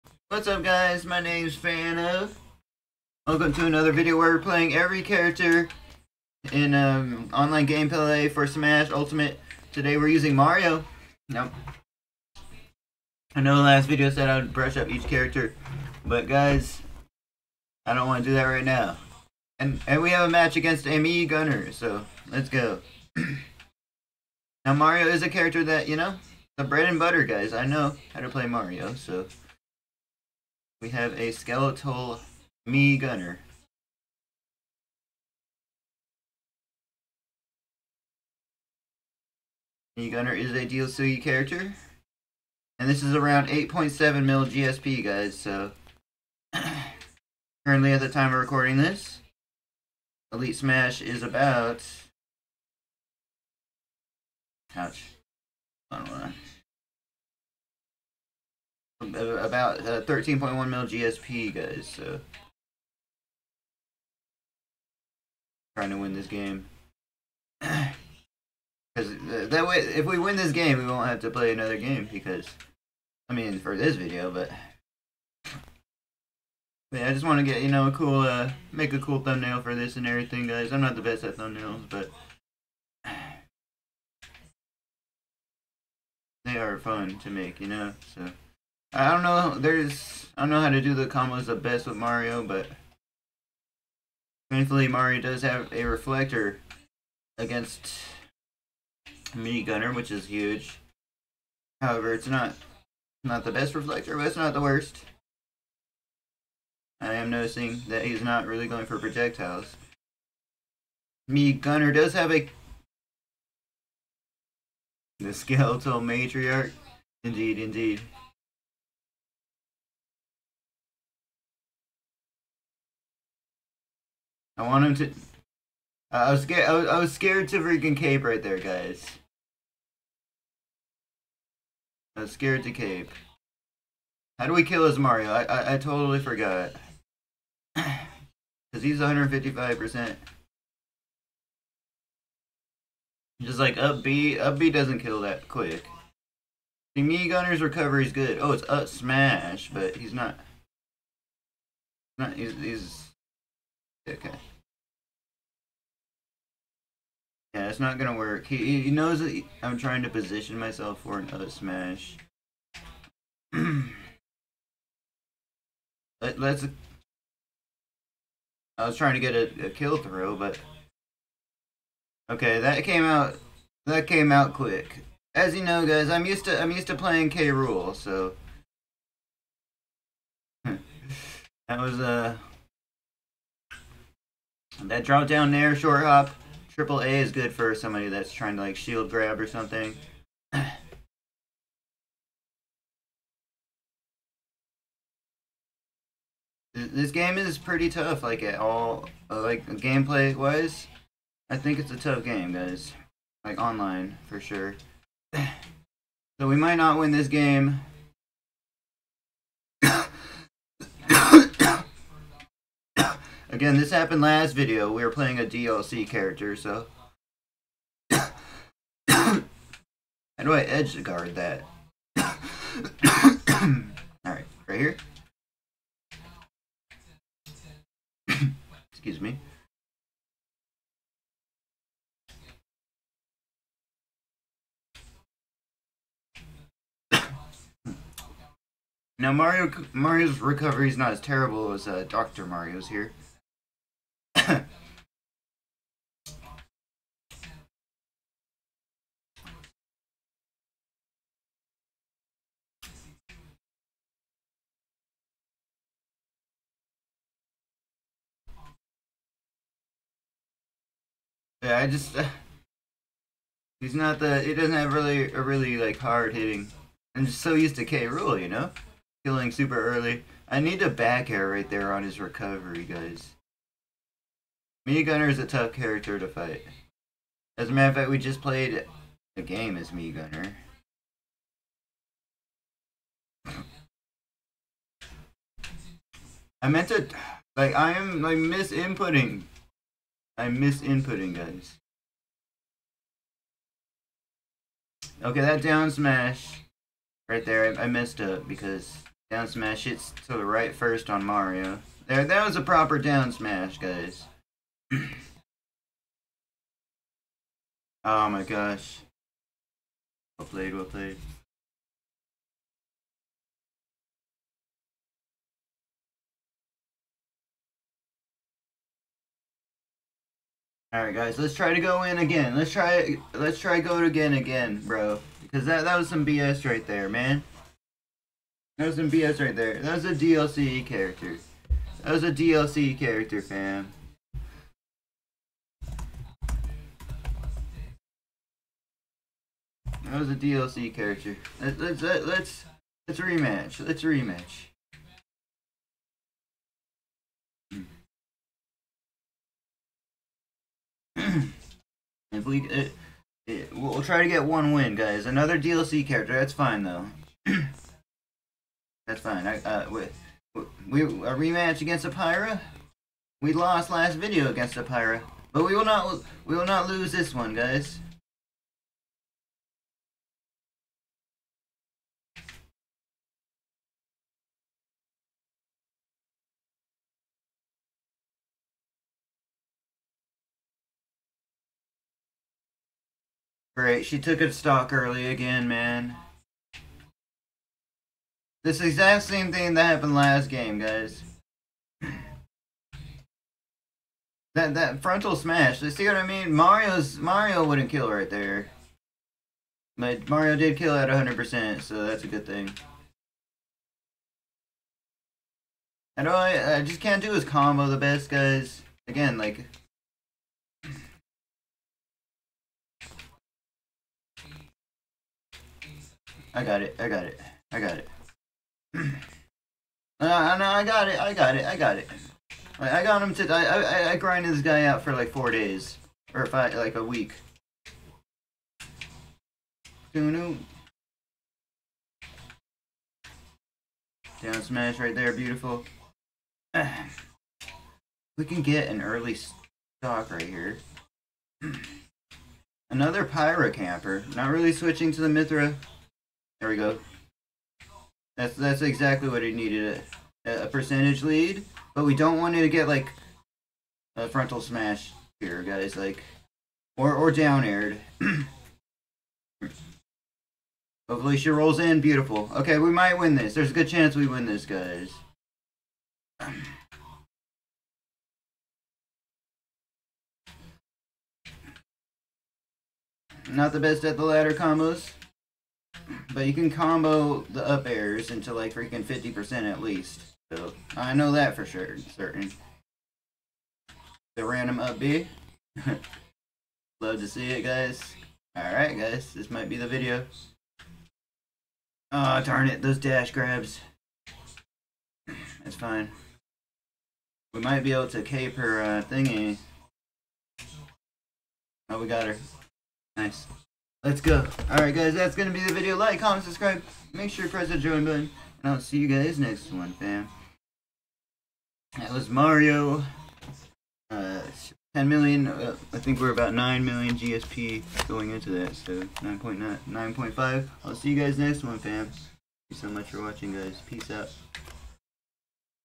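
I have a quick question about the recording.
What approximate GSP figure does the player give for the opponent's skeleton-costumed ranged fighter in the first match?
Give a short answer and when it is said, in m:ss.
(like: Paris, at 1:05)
8.7 million, at 0:43.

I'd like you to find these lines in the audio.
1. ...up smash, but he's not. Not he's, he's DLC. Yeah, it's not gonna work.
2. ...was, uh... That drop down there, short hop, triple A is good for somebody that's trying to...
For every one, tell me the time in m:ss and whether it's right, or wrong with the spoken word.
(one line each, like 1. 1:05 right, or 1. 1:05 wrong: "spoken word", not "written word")
1. 2:28 wrong: "Okay", not "DLC"
2. 3:01 right.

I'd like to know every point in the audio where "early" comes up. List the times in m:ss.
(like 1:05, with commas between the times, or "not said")
4:29, 6:24, 7:19.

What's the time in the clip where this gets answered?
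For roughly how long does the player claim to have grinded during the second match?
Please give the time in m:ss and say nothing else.
7:06.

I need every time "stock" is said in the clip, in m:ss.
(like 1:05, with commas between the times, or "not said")
6:24, 7:19.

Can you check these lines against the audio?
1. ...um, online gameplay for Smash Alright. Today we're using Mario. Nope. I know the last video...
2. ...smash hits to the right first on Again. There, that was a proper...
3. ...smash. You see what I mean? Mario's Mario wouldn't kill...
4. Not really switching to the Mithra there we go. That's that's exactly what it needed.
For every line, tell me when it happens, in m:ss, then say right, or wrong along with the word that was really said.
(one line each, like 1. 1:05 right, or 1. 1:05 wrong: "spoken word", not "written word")
1. 0:06 wrong: "Ultimate", not "Alright"
2. 4:59 wrong: "Mario", not "Again"
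3. 6:35 right
4. 7:24 right.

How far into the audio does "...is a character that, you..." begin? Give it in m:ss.
0:25.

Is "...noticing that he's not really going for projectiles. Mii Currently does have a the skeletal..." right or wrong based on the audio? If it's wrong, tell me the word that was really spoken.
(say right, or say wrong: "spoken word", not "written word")
wrong: "Gunner", not "Currently".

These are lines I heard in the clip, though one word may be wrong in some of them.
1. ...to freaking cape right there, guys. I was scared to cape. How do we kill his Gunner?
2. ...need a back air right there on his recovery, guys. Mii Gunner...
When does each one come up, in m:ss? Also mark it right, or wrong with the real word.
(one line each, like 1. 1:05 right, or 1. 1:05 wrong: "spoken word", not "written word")
1. 2:07 wrong: "Mario", not "Gunner"
2. 4:30 right.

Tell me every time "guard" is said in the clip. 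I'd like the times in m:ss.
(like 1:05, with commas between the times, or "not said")
3:41.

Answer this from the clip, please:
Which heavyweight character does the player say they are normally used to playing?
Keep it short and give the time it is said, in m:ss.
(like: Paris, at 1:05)
K. Rool, at 2:57.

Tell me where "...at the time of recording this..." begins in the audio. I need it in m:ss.
0:47.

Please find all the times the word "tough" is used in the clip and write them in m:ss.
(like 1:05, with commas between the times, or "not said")
3:17, 3:21, 4:35.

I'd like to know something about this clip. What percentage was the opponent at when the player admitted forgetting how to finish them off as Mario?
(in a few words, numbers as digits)
155 percent.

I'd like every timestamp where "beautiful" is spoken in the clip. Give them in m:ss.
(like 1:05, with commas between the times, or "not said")
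7:15, 7:41.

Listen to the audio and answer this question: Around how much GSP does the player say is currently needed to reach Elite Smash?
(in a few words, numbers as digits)
13.1 million.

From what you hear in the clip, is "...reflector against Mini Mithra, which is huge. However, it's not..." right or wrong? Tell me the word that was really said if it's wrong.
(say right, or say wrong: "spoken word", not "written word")
wrong: "Gunner", not "Mithra".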